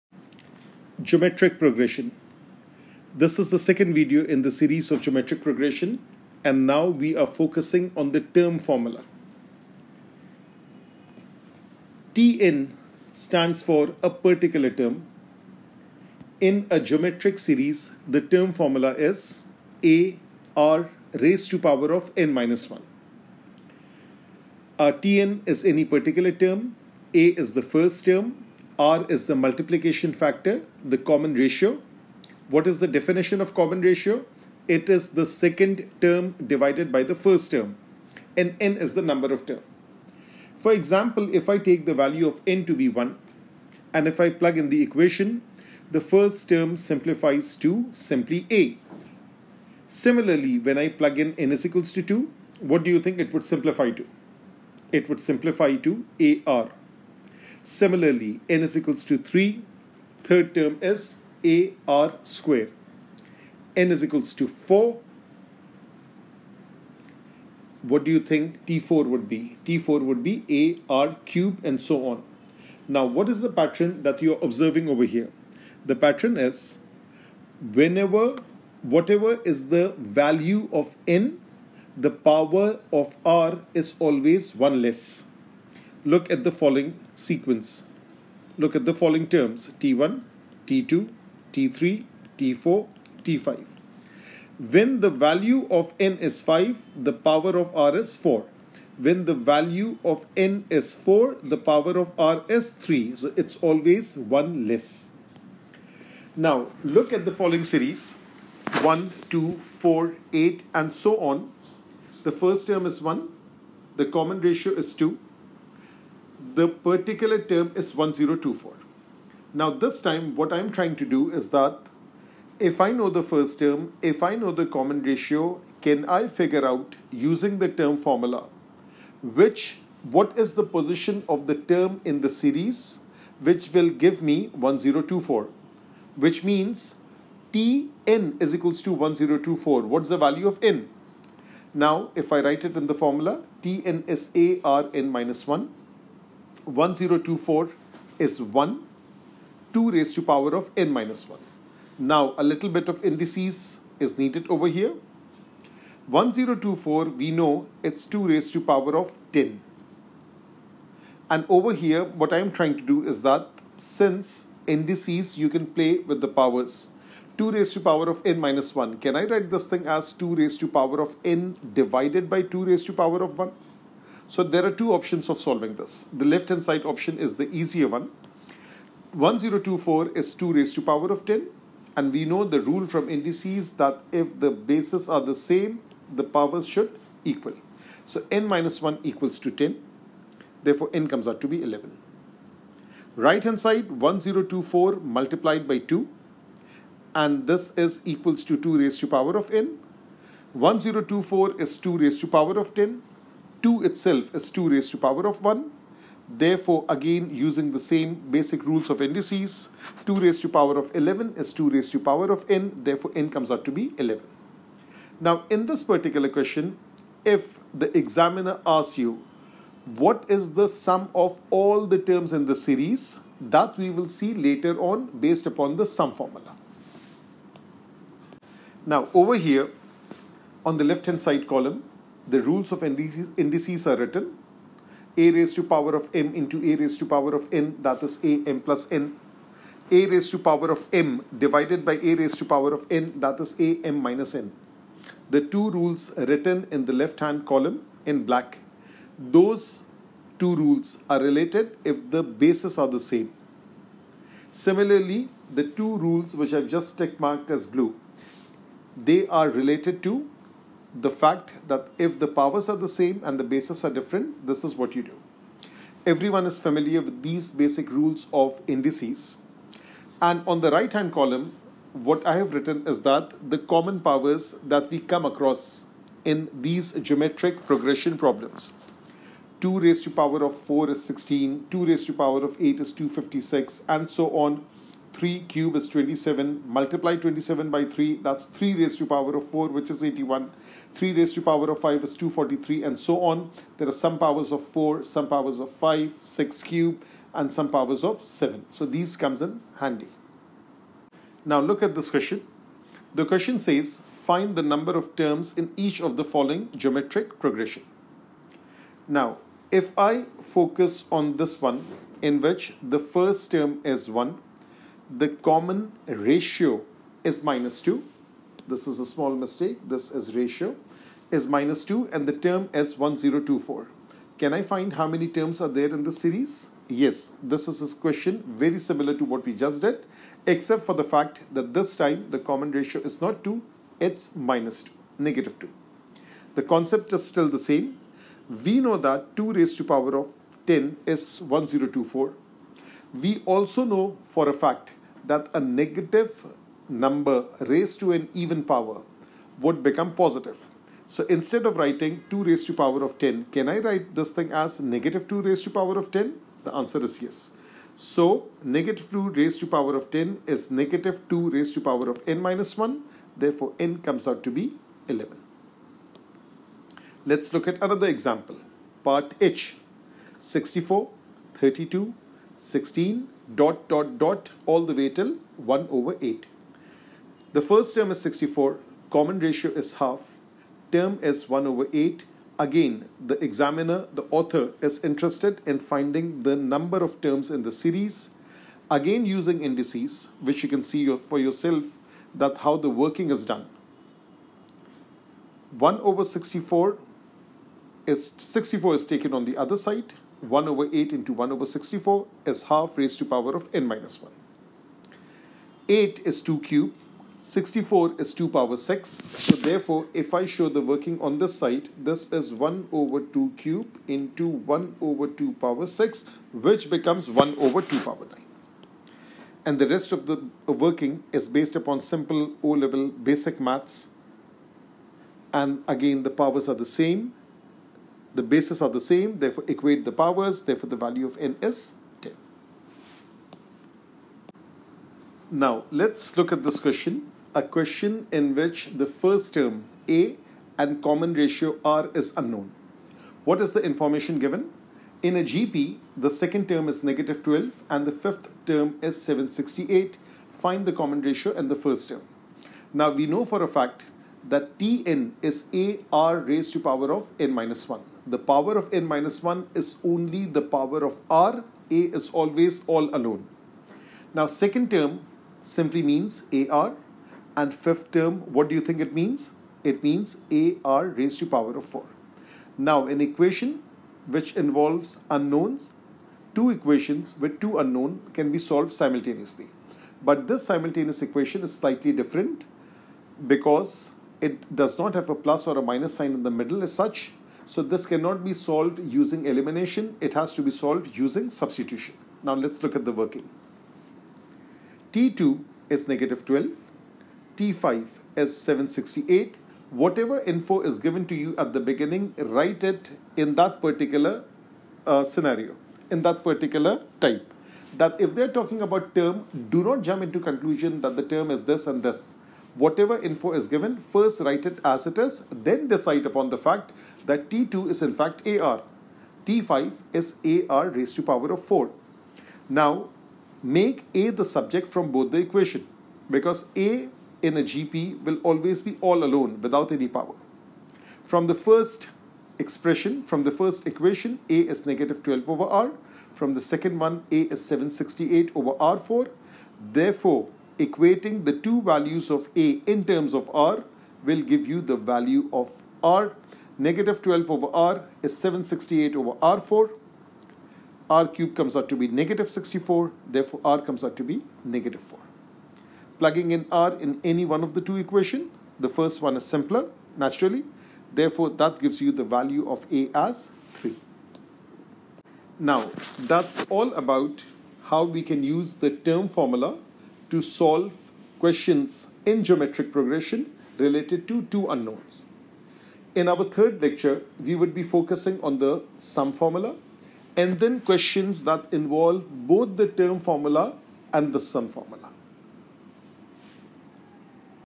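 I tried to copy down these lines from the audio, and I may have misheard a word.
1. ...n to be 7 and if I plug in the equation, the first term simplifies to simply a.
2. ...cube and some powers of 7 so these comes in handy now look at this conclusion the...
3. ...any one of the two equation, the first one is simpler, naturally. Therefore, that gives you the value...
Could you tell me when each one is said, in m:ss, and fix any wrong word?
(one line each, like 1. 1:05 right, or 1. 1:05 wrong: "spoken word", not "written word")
1. 0:42 wrong: "1", not "7"
2. 4:56 wrong: "question", not "conclusion"
3. 9:17 right.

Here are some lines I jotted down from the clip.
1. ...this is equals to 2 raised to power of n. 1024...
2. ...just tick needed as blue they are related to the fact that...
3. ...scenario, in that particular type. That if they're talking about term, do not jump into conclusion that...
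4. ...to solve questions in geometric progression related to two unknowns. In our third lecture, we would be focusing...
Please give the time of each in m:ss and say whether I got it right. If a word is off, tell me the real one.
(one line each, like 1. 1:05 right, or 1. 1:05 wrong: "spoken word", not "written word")
1. 3:17 right
2. 4:16 wrong: "marked", not "needed"
3. 8:25 right
4. 9:30 right.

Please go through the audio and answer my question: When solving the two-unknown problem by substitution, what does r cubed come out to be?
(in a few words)
-64.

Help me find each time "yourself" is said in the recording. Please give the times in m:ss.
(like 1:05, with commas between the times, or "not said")
6:31.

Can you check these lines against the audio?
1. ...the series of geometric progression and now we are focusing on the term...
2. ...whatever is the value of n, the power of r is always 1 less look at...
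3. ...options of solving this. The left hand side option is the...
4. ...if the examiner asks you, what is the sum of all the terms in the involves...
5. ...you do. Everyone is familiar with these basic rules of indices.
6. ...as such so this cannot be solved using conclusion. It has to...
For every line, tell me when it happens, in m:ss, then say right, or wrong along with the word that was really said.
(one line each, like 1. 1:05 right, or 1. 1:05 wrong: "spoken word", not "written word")
1. 0:04 right
2. 1:18 right
3. 2:54 right
4. 3:37 wrong: "series", not "involves"
5. 4:24 right
6. 8:06 wrong: "elimination", not "conclusion".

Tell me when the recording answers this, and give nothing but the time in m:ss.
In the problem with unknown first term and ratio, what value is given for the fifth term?
7:28.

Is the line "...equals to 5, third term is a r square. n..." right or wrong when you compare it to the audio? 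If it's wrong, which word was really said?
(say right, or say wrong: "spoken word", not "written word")
wrong: "3", not "5".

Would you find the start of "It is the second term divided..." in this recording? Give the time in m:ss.
0:34.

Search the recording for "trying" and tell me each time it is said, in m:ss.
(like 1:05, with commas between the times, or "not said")
2:00, 2:42.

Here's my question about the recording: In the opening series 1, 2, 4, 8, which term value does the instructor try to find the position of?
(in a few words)
1024.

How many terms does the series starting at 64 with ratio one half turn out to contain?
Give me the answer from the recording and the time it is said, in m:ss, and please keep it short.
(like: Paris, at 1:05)
10, at 7:10.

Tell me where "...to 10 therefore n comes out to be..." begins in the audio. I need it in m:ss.
3:09.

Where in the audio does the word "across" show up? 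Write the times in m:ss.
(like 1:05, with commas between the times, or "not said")
4:35.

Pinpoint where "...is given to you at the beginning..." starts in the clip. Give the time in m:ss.
8:20.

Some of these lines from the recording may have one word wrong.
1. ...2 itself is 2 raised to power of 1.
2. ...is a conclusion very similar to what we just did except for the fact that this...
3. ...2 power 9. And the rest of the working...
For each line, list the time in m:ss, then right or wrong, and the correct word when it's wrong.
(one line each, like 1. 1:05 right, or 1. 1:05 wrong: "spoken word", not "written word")
1. 3:23 right
2. 5:27 wrong: "question", not "conclusion"
3. 6:57 right.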